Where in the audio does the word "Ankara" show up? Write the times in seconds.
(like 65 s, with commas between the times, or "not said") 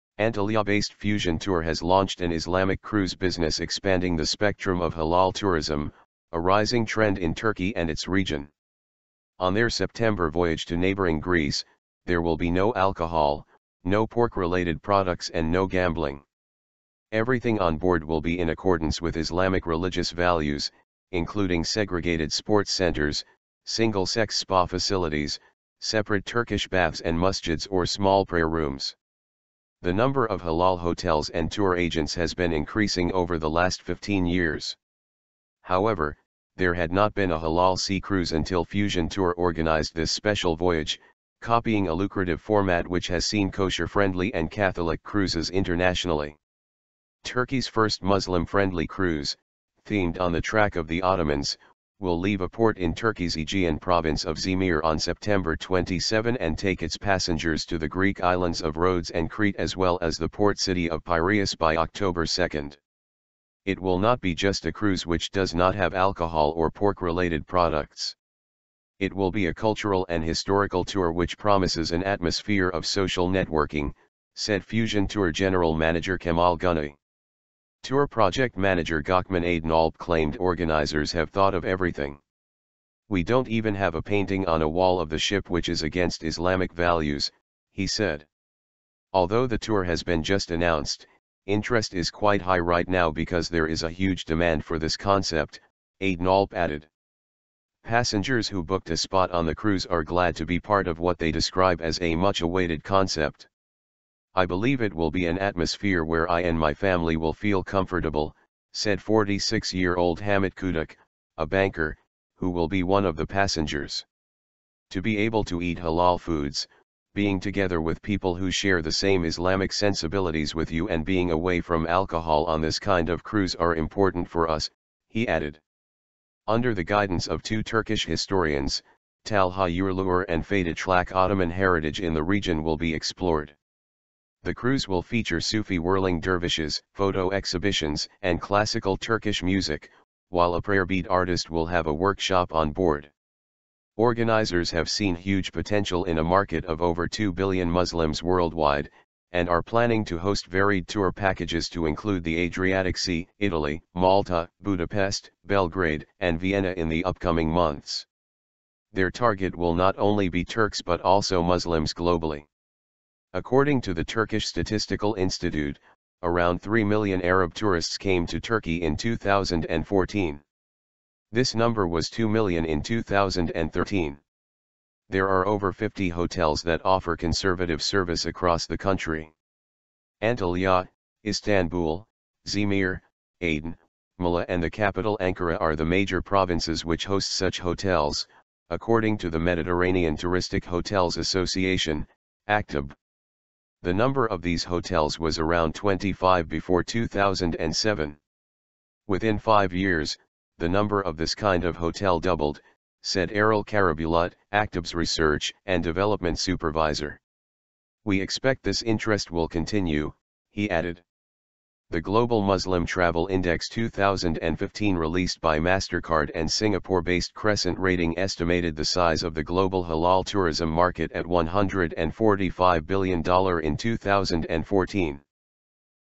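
185 s.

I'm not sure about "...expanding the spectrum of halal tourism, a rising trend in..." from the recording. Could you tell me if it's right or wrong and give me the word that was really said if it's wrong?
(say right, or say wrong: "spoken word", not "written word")
right.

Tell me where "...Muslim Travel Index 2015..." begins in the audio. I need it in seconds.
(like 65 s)
212 s.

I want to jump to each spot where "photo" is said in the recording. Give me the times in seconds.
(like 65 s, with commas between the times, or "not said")
136 s.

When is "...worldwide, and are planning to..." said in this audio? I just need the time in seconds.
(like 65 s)
148 s.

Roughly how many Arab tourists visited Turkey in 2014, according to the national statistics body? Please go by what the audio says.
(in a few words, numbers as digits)
3 million.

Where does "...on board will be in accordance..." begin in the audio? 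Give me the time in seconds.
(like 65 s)
17 s.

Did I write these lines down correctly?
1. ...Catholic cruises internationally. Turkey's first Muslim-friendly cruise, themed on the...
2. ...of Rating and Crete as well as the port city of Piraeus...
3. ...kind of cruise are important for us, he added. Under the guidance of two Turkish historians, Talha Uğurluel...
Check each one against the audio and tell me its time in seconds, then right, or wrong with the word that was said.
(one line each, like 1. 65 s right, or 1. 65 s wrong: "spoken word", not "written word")
1. 44 s right
2. 58 s wrong: "Rhodes", not "Rating"
3. 122 s right.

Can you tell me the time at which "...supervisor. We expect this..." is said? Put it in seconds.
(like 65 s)
206 s.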